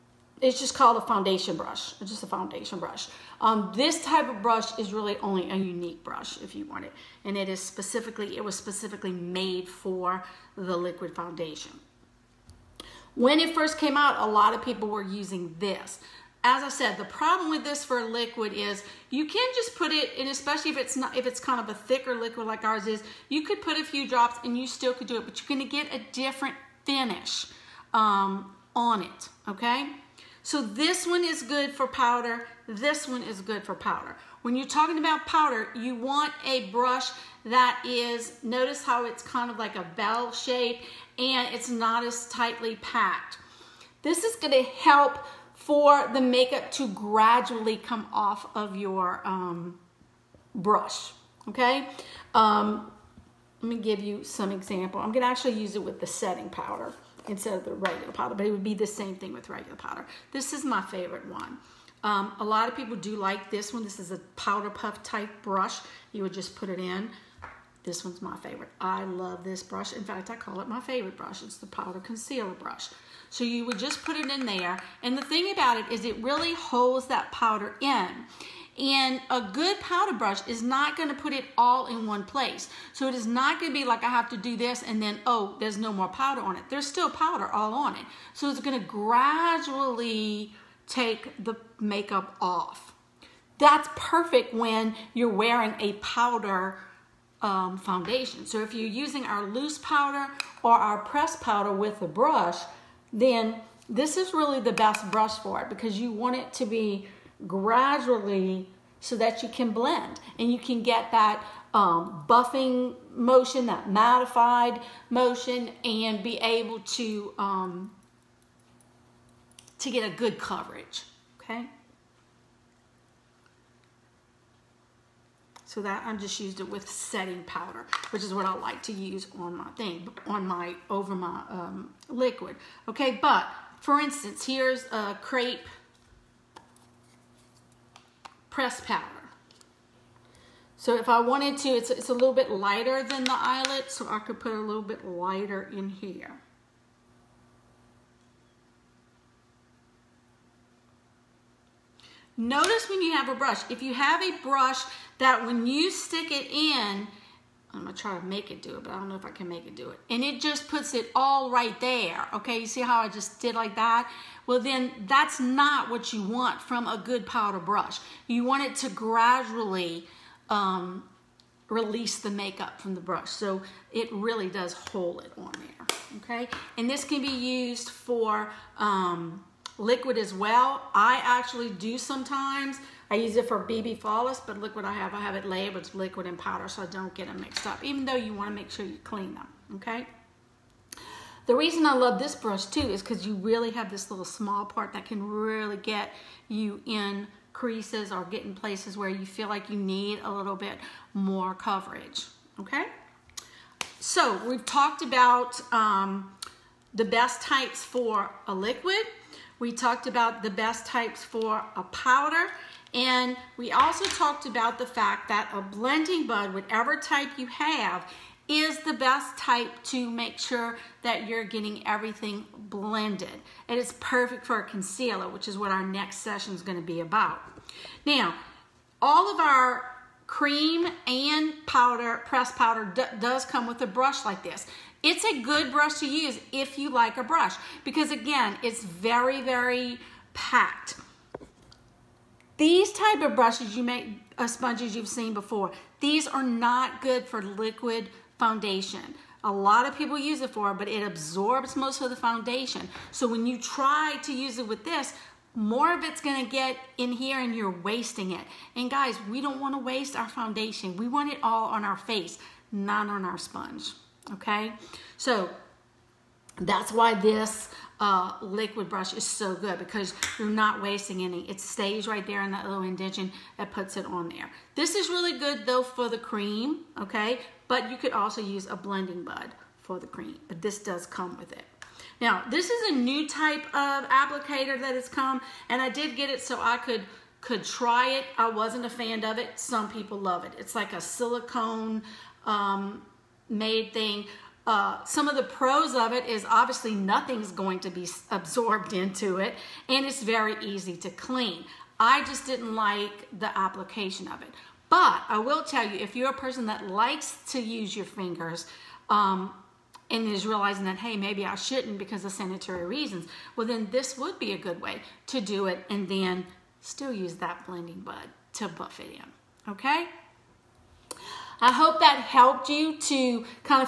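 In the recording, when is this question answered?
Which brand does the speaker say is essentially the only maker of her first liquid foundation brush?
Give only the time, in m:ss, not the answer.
0:05.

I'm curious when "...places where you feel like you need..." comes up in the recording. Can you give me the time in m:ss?
3:18.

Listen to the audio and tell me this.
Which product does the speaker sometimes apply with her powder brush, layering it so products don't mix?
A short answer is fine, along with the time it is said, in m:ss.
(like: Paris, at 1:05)
BB Flawless, at 3:03.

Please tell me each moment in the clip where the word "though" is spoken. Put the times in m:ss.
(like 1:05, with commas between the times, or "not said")
3:08, 4:35.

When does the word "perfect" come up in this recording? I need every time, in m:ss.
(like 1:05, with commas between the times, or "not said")
1:33, 3:43.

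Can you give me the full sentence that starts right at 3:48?
Now, all of our cream and powder, pressed powder, does come with a brush like this.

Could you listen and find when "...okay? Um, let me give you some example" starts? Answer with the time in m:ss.
0:51.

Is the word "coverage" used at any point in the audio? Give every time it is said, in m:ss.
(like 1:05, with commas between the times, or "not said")
2:00, 3:21.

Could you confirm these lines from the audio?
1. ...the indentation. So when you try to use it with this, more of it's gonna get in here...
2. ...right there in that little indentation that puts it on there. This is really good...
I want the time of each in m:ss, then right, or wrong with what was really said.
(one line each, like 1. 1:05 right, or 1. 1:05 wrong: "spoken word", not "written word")
1. 4:12 wrong: "foundation", not "indentation"
2. 4:32 right.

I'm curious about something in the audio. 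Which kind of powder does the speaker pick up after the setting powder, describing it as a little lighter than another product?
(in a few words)
crepe press powder.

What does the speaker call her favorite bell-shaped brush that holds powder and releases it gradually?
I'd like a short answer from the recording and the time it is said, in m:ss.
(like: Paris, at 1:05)
powder concealer brush, at 1:11.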